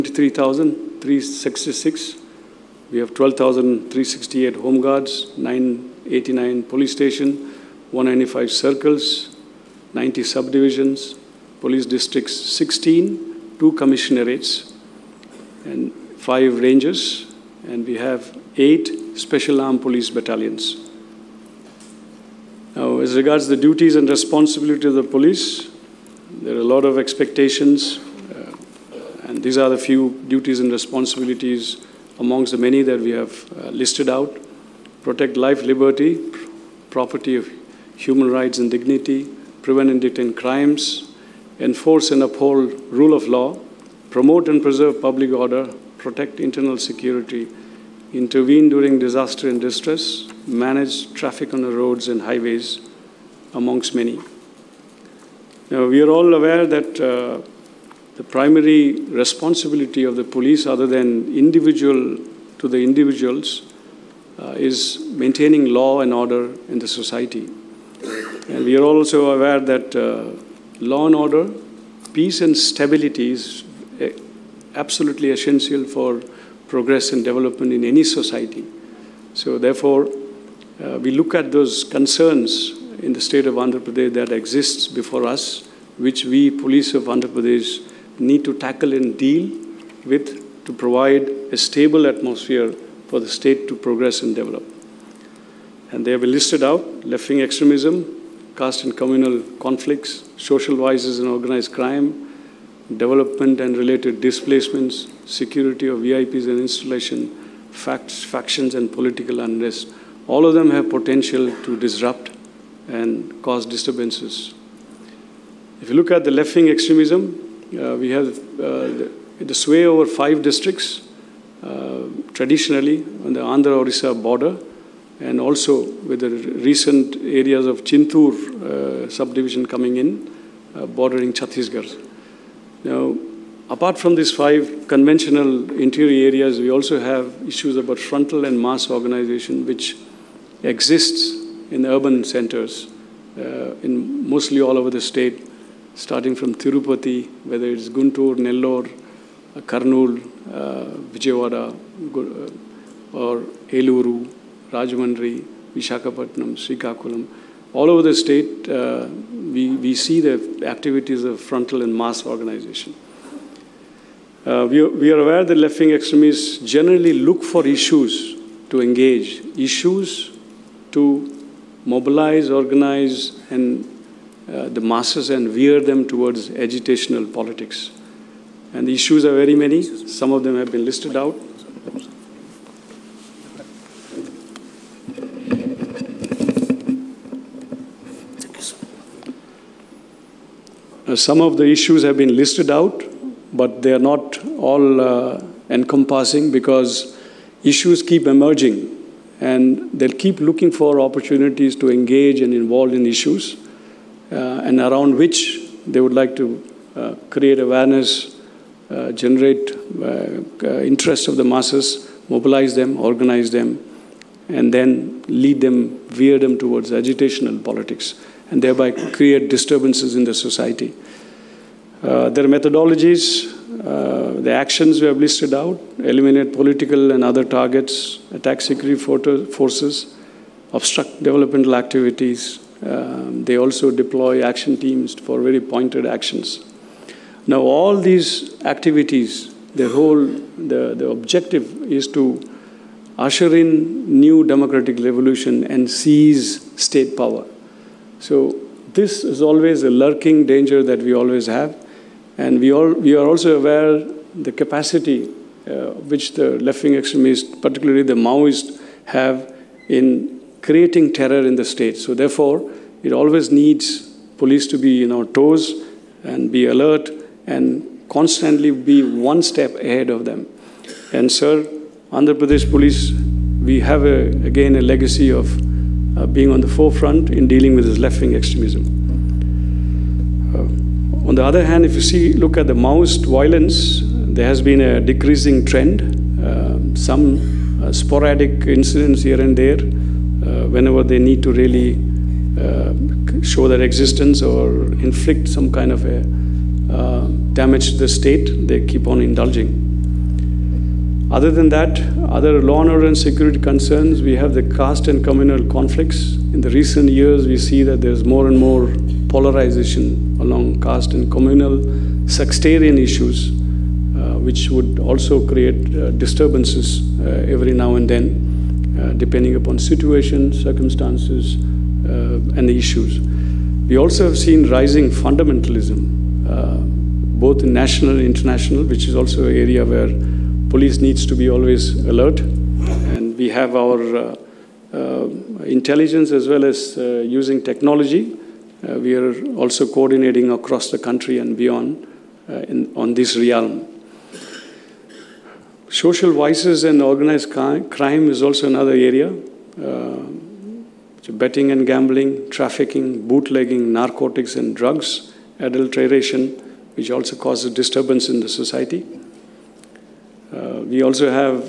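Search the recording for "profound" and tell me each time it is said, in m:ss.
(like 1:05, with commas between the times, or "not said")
not said.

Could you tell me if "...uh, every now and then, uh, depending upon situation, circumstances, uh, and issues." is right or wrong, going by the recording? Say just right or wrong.
right.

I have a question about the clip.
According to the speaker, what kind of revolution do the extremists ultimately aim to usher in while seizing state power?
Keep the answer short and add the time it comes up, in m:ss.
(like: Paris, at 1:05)
New democratic revolution, at 4:04.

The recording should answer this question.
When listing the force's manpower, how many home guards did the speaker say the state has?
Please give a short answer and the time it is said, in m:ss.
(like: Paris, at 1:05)
12,368, at 0:03.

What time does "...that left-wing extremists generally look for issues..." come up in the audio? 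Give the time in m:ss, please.
2:45.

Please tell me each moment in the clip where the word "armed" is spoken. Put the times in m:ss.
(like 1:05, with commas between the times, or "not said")
0:19.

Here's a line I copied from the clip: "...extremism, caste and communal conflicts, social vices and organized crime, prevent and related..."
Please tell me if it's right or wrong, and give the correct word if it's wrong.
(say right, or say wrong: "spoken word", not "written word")
wrong: "development", not "prevent".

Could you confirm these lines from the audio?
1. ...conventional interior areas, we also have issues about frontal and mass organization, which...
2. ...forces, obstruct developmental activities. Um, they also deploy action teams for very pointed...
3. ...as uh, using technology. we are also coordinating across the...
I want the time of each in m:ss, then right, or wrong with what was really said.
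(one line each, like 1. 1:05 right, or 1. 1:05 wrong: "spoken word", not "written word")
1. 2:14 right
2. 3:49 right
3. 5:36 right.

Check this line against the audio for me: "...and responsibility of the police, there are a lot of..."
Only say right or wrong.
right.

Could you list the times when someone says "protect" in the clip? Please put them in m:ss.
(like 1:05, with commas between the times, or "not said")
0:35, 0:46.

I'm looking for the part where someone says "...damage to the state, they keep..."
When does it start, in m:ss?
4:57.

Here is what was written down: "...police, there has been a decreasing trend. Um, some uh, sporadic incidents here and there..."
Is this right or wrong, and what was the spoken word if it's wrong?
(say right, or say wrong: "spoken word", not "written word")
wrong: "violence", not "police".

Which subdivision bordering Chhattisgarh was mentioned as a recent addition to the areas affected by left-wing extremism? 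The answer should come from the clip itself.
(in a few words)
Chintur.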